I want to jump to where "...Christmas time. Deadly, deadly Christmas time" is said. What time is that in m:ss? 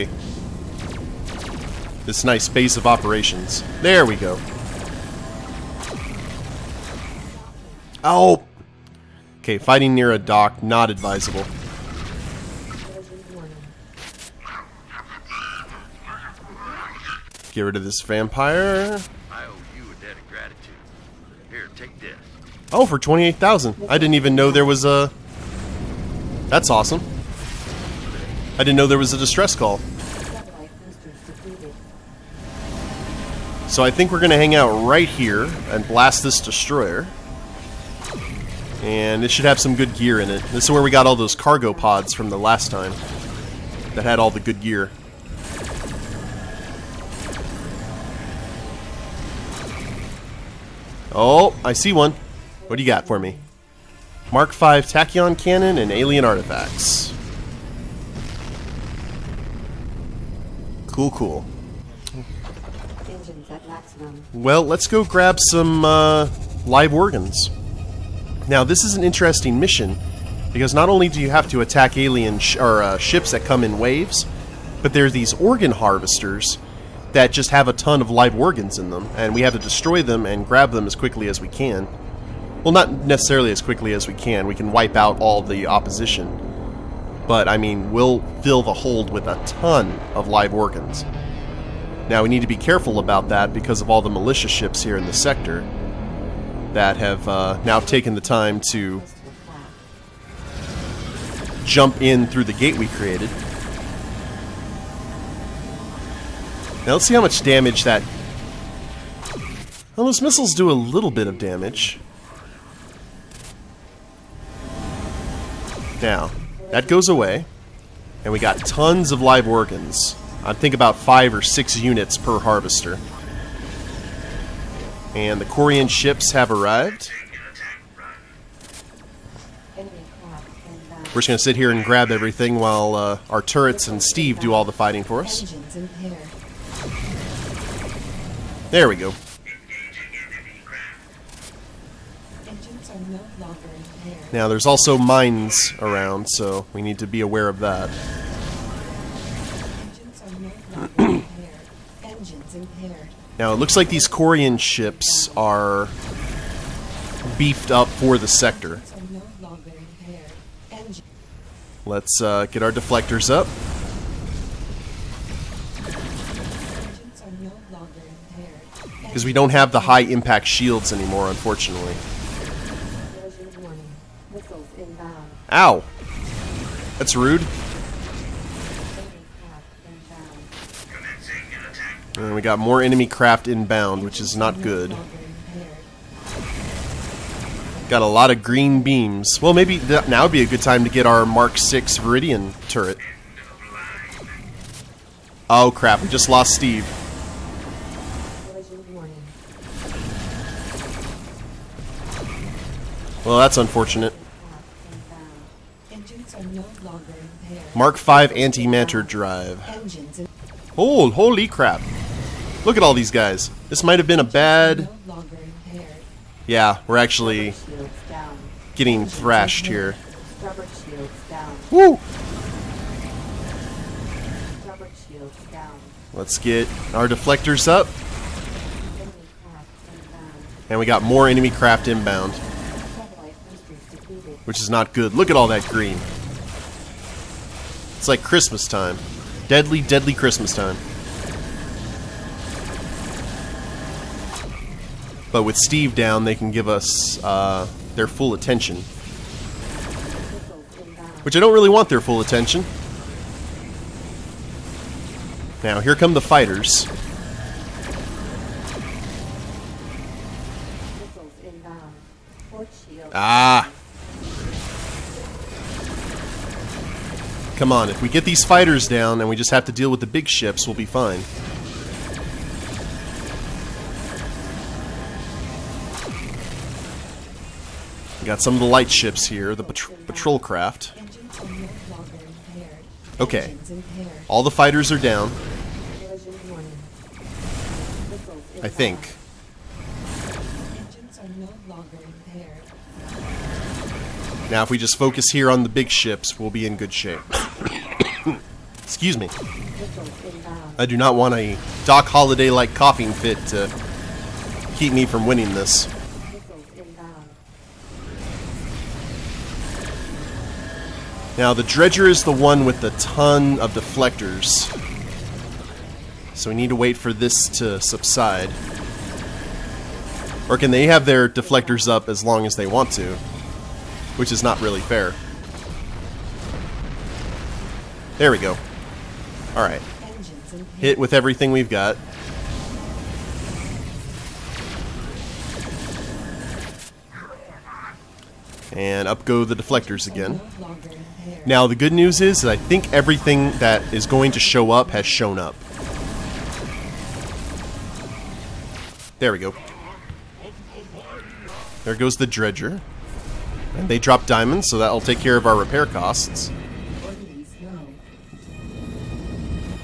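3:58.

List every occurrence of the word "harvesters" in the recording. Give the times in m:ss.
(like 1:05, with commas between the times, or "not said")
1:15, 2:02.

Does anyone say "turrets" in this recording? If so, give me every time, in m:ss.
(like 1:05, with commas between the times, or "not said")
2:13, 3:12.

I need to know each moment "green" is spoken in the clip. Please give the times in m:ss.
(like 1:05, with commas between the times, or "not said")
3:08, 3:55.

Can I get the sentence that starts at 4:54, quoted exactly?
Now, if we just focus here on the big ships, we'll be in good shape.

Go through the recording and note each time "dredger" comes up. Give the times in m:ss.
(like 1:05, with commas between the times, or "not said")
5:11, 5:52.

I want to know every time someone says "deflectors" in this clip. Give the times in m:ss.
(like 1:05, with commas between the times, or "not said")
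2:42, 3:47, 5:13, 5:21, 5:39.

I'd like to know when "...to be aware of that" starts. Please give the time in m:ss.
2:26.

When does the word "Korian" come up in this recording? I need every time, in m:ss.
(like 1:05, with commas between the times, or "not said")
2:05, 2:34.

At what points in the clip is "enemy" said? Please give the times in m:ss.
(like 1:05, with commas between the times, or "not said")
3:02, 3:51.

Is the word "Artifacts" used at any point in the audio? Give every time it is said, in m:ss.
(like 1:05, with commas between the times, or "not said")
0:56.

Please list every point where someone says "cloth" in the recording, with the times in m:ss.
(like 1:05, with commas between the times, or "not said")
not said.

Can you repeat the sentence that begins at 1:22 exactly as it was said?
Well, not necessarily as quickly as we can.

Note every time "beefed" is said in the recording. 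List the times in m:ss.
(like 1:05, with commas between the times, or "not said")
2:37.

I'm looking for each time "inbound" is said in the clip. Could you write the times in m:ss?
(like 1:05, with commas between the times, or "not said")
3:03, 3:51.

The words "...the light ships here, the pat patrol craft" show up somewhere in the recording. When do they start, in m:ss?
4:38.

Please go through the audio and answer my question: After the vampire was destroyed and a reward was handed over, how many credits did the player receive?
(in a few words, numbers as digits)
28,000.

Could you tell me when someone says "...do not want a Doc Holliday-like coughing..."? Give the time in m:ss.
5:00.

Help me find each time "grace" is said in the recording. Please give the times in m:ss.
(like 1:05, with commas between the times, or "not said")
not said.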